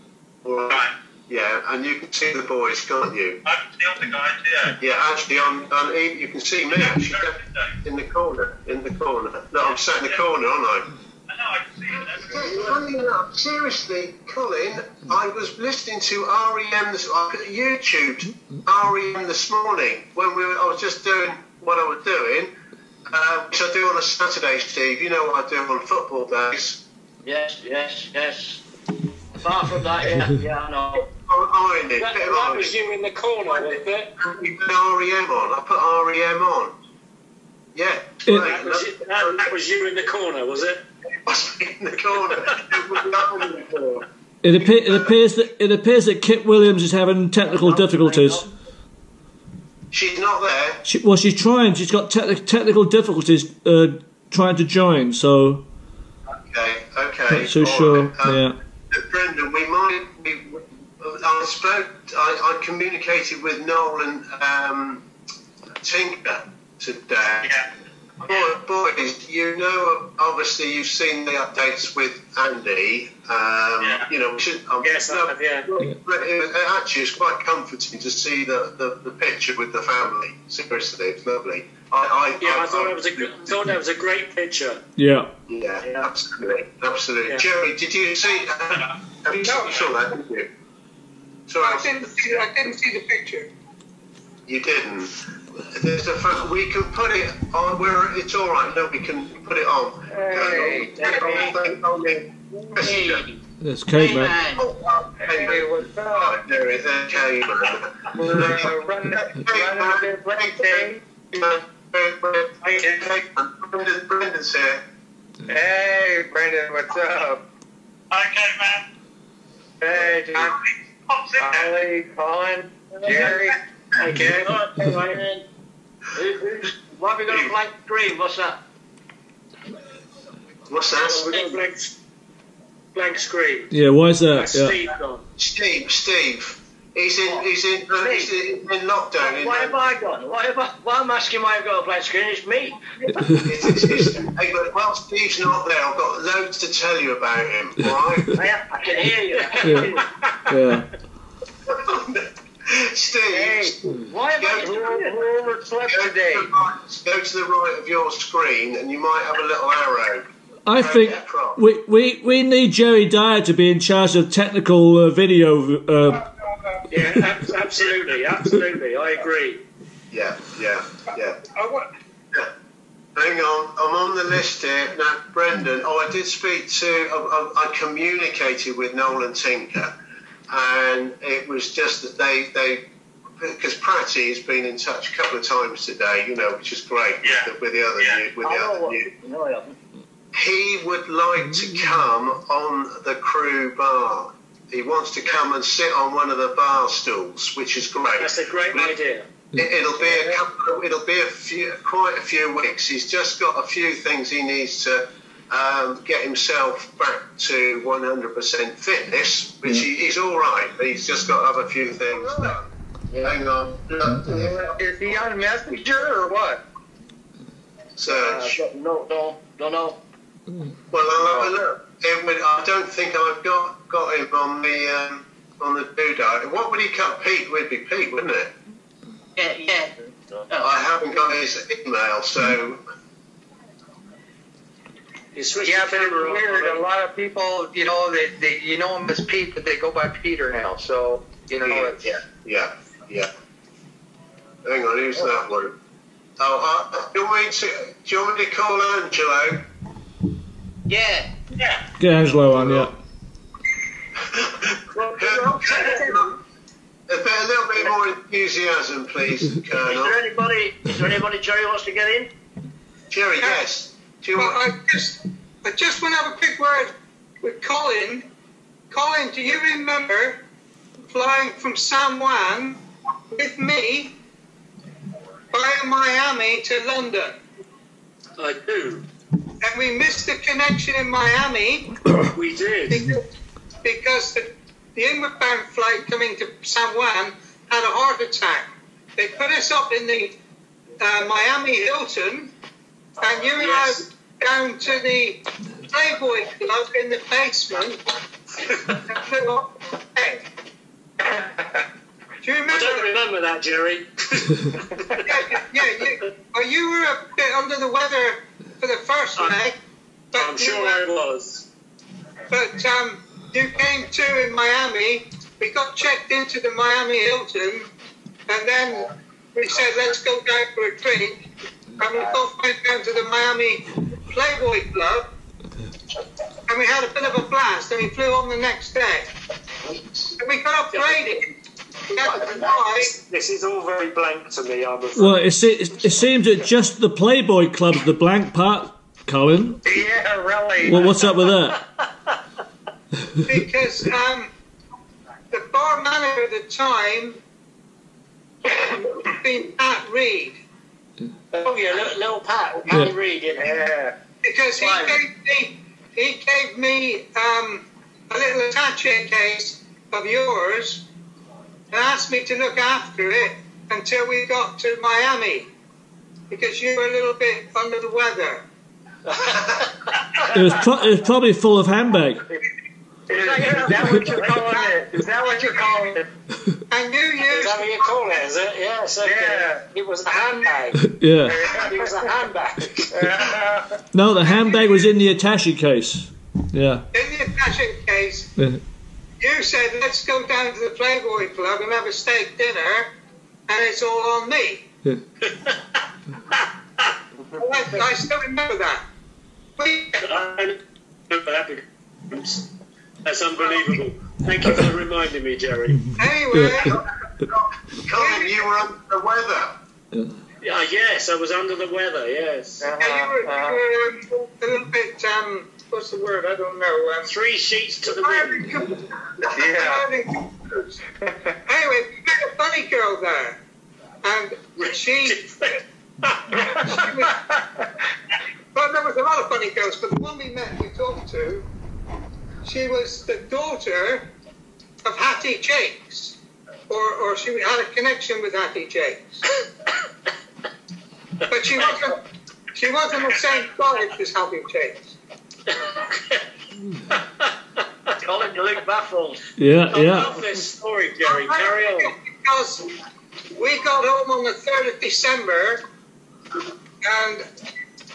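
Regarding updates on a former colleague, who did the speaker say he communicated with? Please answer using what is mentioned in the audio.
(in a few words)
Nolan Tinker.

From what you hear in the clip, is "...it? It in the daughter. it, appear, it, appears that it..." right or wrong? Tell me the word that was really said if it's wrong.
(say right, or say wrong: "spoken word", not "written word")
wrong: "corner", not "daughter".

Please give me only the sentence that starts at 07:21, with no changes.
but she wasn't, she wasn't the same college as Hattie Jacques.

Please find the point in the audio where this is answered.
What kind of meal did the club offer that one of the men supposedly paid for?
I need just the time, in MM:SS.
06:32.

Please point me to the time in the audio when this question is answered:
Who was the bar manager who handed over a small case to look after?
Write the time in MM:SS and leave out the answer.
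05:49.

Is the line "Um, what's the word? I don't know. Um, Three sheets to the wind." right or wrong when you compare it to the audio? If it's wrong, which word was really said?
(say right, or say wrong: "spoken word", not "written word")
right.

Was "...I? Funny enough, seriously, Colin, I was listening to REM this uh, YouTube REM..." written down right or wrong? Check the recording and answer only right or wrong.
right.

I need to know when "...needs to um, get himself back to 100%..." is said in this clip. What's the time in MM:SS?
03:24.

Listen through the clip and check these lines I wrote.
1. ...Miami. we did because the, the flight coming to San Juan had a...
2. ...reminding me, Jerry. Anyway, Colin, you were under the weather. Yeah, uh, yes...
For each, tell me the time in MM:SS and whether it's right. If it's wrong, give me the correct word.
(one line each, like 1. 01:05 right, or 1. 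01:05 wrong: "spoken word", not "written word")
1. 04:41 right
2. 06:44 right.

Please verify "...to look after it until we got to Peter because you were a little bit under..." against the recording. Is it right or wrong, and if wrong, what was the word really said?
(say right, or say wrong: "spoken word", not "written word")
wrong: "Miami", not "Peter".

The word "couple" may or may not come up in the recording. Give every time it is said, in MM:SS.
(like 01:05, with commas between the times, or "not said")
03:05, 03:20.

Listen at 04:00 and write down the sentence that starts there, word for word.
So you know, yeah, it's, yeah, yeah, yeah.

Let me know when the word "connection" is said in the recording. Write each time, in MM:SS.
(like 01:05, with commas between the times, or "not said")
04:40, 07:17.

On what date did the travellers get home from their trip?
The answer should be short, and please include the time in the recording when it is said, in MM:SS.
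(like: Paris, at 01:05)
3rd of December, at 07:34.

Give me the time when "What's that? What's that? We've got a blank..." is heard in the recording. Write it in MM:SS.
02:08.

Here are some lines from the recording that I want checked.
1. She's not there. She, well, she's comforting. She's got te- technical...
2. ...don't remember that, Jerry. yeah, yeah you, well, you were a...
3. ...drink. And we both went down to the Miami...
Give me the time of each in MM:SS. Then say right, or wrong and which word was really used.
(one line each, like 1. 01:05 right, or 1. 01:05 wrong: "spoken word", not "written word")
1. 00:49 wrong: "trying", not "comforting"
2. 05:02 right
3. 05:20 right.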